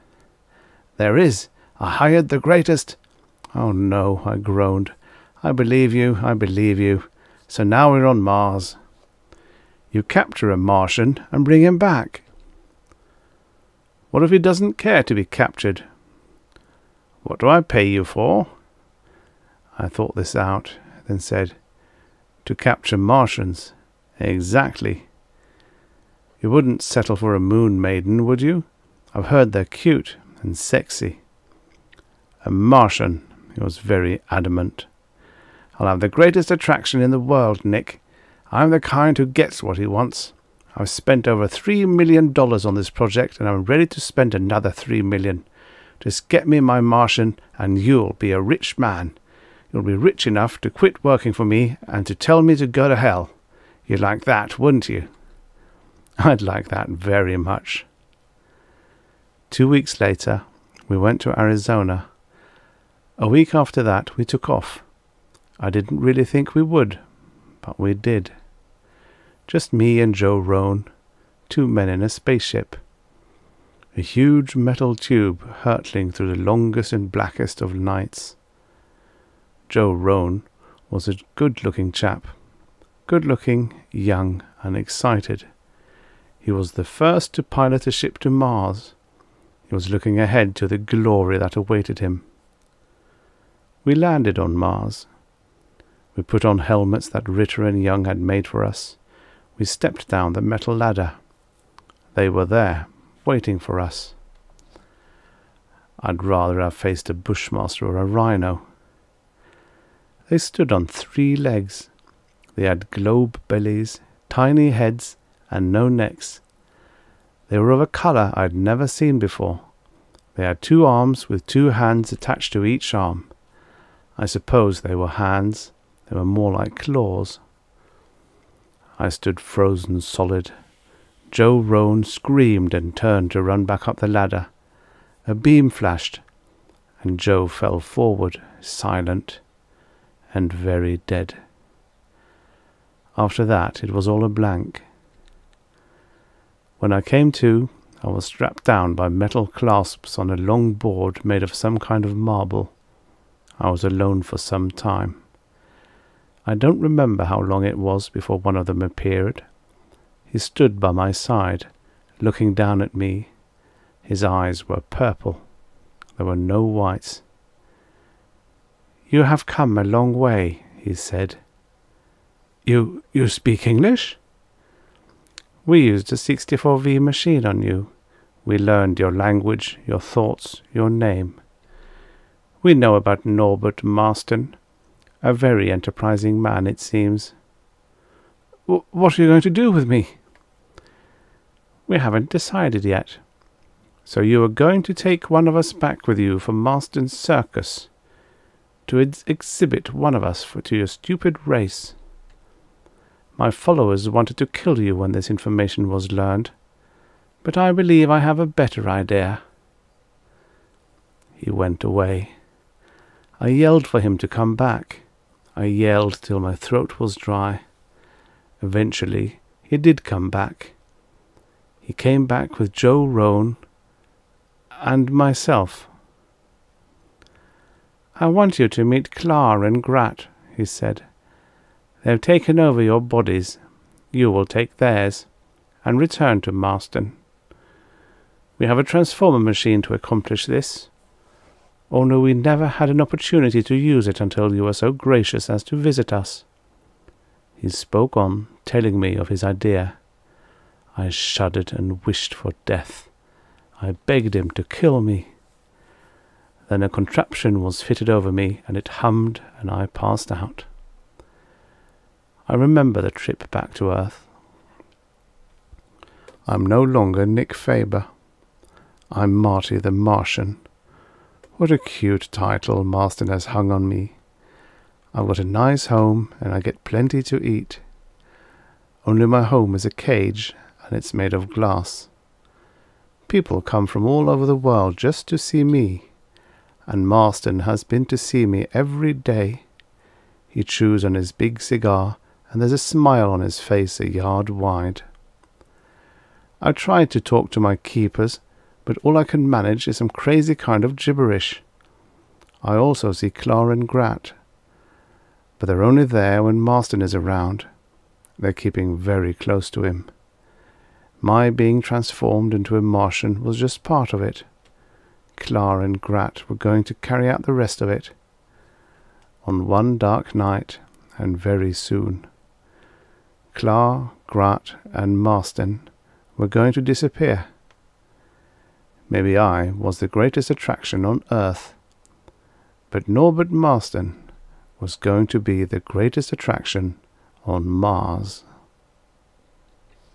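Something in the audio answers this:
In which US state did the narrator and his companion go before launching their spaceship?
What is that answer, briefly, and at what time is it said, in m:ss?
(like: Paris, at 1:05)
Arizona, at 1:01.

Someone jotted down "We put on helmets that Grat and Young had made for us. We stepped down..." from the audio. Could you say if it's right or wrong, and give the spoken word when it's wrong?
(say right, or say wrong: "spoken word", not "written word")
wrong: "Ritter", not "Grat".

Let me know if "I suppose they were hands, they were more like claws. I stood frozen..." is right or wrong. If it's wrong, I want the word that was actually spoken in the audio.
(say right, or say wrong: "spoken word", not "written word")
right.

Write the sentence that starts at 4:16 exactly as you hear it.
Then a contraption was fitted over me, and it hummed, and I passed out.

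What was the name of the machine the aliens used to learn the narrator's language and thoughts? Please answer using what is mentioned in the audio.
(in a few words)
64V machine.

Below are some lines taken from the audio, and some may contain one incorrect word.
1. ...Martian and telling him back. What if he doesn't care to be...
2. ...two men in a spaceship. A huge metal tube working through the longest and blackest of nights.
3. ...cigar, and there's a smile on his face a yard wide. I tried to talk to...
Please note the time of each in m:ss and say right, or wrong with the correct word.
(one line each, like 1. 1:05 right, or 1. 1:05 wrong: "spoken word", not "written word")
1. 0:10 wrong: "bring", not "telling"
2. 1:11 wrong: "hurtling", not "working"
3. 4:51 right.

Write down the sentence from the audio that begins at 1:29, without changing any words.
He was looking ahead to the glory that awaited him.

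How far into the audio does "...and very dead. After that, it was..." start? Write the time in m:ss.
2:20.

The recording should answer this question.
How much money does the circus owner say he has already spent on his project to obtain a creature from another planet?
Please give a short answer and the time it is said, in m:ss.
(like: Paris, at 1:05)
$3 million, at 0:41.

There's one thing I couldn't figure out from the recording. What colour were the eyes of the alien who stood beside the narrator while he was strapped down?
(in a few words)
Purple.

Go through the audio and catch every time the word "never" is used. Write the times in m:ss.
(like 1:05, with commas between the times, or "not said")
1:58, 4:02.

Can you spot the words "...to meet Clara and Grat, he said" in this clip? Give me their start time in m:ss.
3:48.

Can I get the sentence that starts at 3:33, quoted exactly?
I yelled for him to come back.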